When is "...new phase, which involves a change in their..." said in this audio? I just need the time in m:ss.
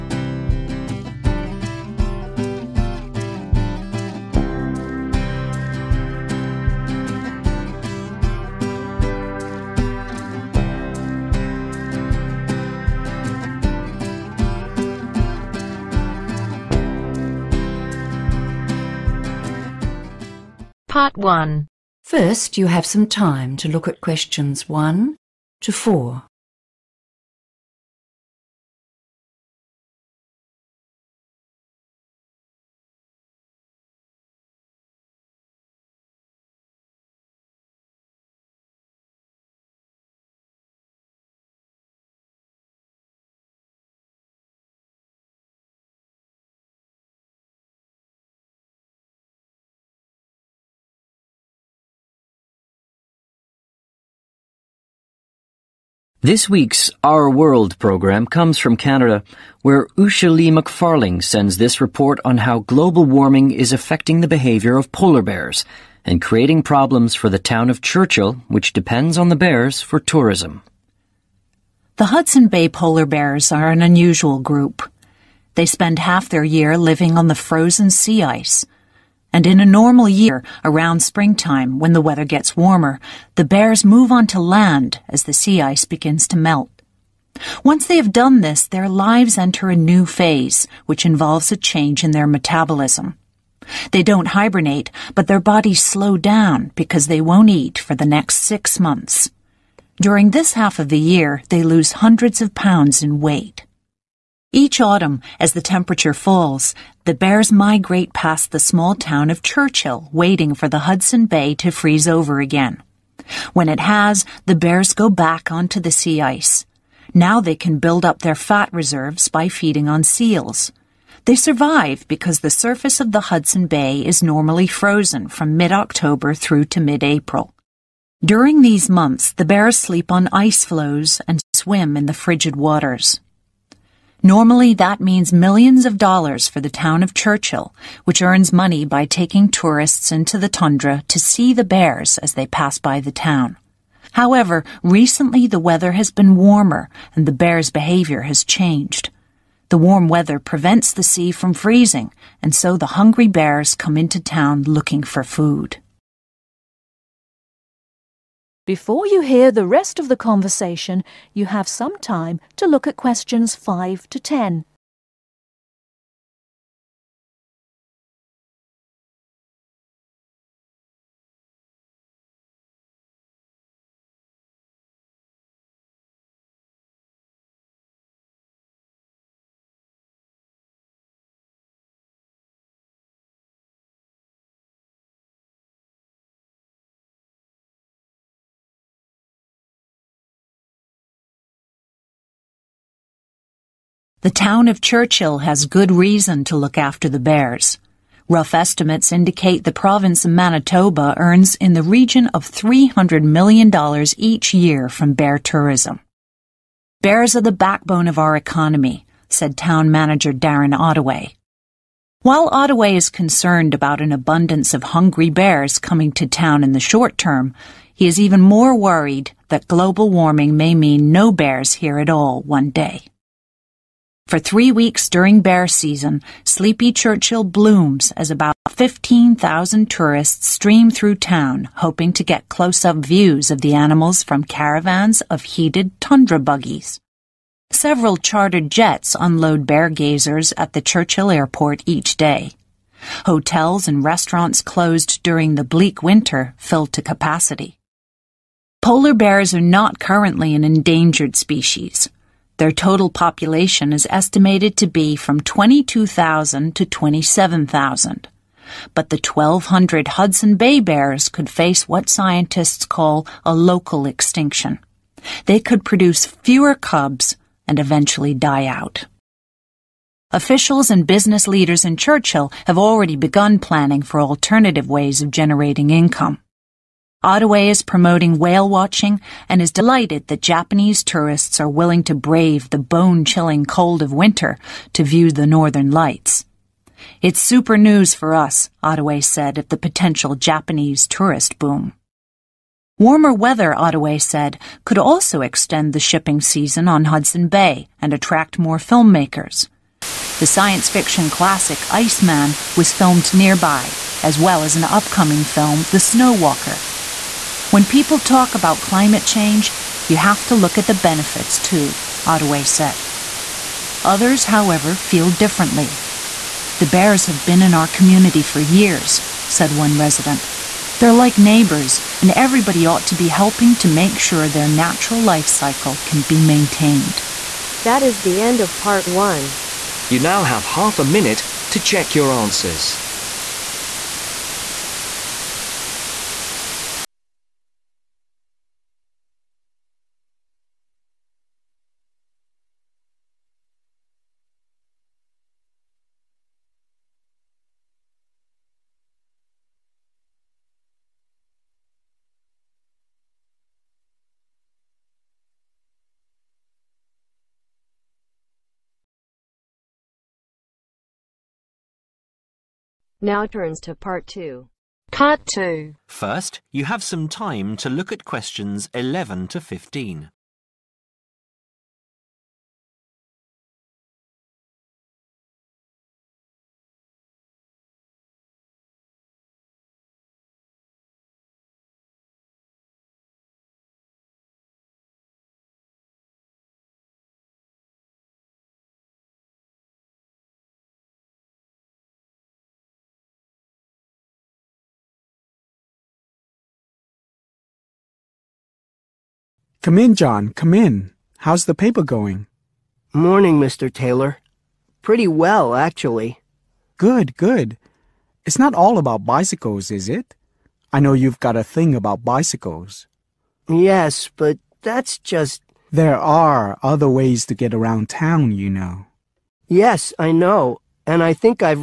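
1:29.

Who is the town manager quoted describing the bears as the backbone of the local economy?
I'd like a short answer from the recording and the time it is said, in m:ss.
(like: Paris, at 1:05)
Darren Ottaway, at 3:30.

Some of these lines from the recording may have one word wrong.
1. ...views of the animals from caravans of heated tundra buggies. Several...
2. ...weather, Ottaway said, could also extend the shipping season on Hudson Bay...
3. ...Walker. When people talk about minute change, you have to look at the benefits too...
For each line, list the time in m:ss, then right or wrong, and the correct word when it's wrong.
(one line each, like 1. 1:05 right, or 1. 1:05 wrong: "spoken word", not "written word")
1. 3:52 right
2. 4:53 right
3. 5:06 wrong: "climate", not "minute".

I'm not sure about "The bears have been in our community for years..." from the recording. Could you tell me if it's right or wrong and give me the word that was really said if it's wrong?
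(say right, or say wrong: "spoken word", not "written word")
right.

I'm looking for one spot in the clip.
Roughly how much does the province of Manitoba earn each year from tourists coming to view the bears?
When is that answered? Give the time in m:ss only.
3:22.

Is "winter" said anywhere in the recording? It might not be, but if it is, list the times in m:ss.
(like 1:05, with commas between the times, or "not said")
4:06, 4:44.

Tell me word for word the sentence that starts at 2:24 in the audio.
However, recently the weather has been warmer and the bears' behavior has changed.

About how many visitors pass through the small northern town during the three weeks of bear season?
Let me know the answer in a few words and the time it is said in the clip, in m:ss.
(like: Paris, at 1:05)
15,000, at 3:48.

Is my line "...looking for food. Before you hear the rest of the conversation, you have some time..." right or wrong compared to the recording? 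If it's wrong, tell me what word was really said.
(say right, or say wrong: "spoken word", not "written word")
right.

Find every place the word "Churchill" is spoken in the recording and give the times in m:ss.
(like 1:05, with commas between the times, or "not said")
1:07, 1:49, 2:17, 3:14, 3:46, 4:00, 4:31.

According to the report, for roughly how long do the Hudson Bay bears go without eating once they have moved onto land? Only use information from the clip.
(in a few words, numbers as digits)
6 months.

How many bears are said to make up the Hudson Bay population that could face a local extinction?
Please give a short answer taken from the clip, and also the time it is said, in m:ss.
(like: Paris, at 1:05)
1,200, at 4:19.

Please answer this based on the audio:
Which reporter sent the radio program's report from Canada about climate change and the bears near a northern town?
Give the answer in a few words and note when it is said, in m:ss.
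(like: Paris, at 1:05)
Usha Lee McFarling, at 0:59.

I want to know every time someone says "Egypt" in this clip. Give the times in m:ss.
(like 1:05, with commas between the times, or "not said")
not said.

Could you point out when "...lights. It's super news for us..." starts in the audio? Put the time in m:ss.
4:45.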